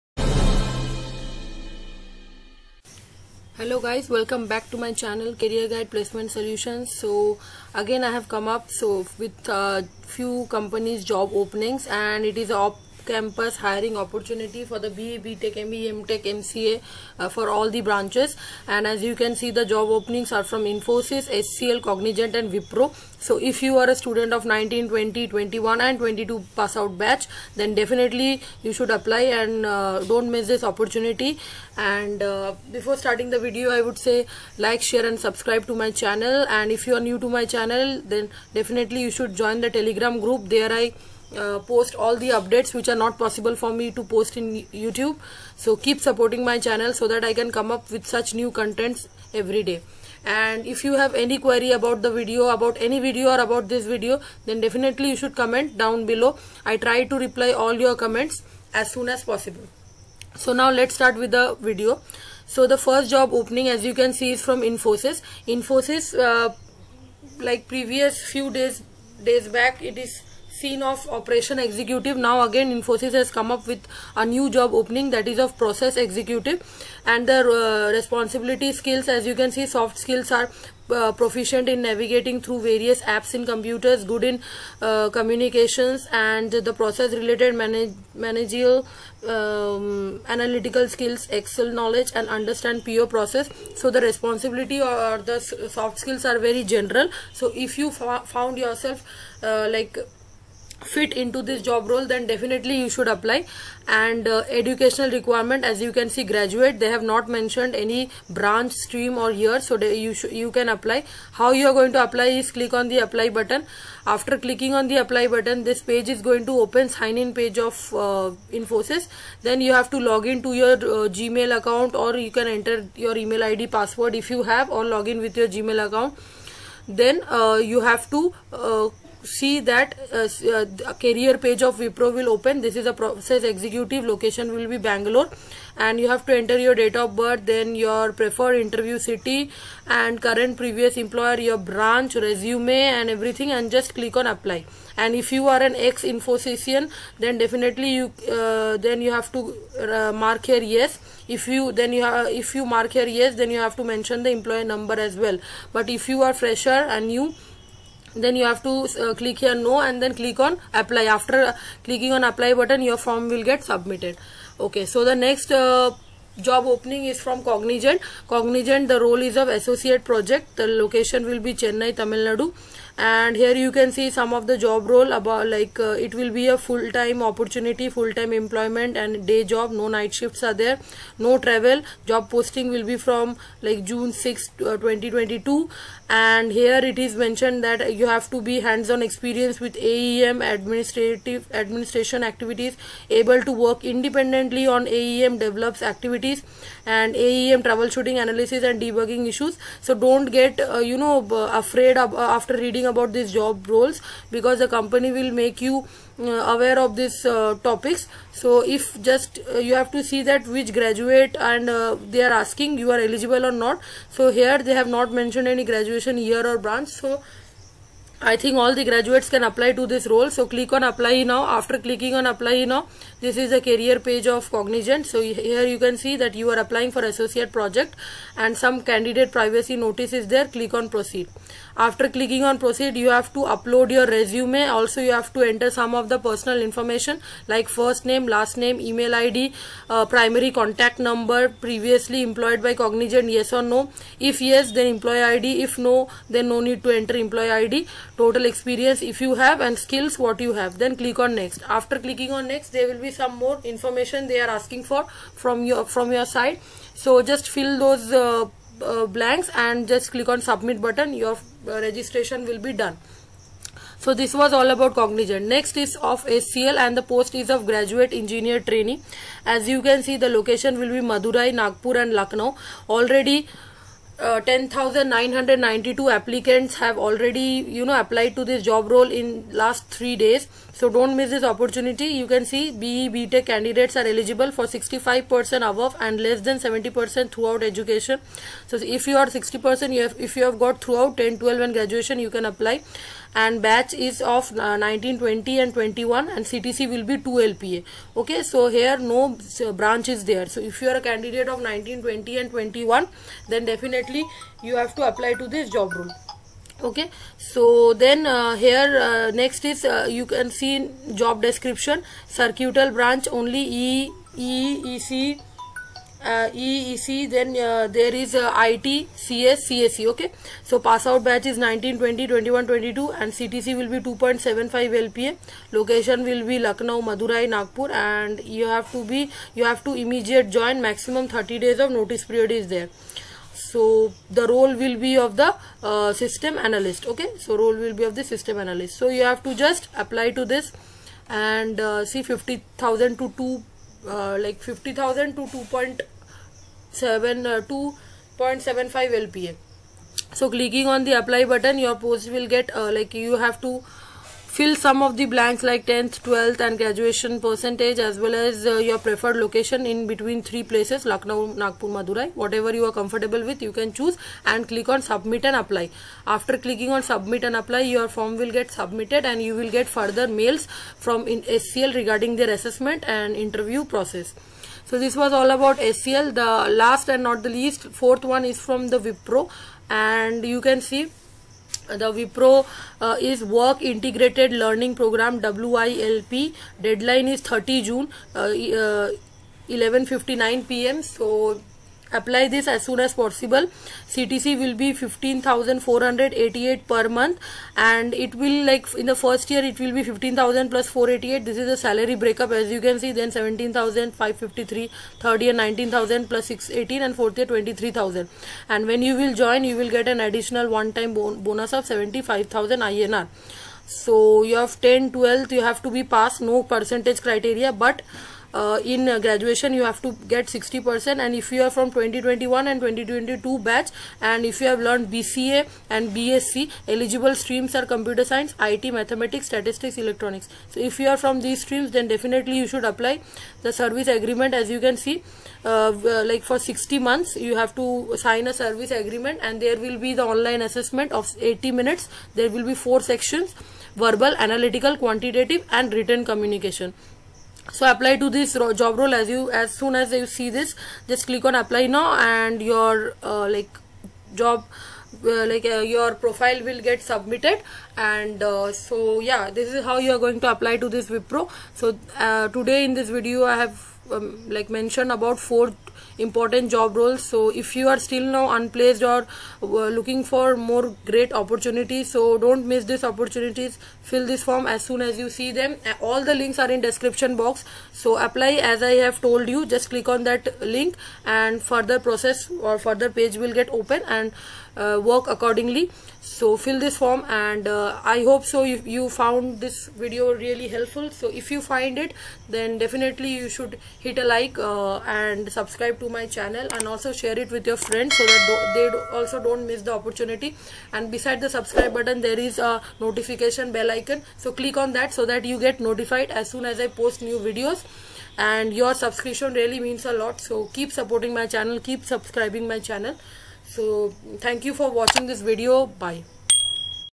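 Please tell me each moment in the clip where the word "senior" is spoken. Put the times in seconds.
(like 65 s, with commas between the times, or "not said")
not said.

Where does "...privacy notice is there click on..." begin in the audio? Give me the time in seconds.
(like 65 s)
229 s.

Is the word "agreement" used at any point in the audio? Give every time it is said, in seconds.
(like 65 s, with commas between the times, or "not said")
434 s, 438 s.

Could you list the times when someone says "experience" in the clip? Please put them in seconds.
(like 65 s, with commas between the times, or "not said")
189 s, 248 s.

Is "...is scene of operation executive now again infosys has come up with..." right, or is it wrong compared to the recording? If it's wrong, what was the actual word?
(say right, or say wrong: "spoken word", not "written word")
right.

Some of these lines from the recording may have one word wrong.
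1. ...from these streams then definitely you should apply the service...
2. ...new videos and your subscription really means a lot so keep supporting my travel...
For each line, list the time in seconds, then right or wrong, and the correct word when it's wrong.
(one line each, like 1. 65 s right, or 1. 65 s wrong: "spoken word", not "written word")
1. 431 s right
2. 507 s wrong: "channel", not "travel".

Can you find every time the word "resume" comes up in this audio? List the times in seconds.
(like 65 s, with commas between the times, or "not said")
142 s, 234 s.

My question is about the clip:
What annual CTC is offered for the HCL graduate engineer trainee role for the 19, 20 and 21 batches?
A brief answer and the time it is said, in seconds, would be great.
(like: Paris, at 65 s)
2 LPA, at 297 s.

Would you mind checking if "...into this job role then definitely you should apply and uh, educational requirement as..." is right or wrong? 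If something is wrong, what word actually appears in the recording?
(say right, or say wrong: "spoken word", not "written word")
right.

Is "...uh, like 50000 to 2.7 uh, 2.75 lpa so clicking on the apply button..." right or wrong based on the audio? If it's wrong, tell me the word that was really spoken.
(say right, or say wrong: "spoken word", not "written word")
right.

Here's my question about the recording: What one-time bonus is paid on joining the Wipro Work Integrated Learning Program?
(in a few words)
75000 INR.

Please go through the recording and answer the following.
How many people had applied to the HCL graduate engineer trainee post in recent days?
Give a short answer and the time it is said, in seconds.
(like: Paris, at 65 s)
10,992, at 274 s.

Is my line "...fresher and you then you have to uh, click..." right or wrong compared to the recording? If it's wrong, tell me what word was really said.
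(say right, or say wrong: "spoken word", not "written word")
right.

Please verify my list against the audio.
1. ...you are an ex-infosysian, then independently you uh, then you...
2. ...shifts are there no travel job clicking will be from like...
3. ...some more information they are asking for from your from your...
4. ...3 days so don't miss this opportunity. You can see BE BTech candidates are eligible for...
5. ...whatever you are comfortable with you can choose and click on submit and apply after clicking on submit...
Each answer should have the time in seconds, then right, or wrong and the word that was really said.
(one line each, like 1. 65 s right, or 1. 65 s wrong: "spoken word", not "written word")
1. 145 s wrong: "definitely", not "independently"
2. 180 s wrong: "posting", not "clicking"
3. 253 s right
4. 279 s right
5. 362 s right.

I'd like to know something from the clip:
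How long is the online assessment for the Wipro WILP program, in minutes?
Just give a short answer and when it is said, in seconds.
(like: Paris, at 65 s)
80 minutes, at 441 s.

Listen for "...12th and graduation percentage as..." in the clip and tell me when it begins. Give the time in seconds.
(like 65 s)
356 s.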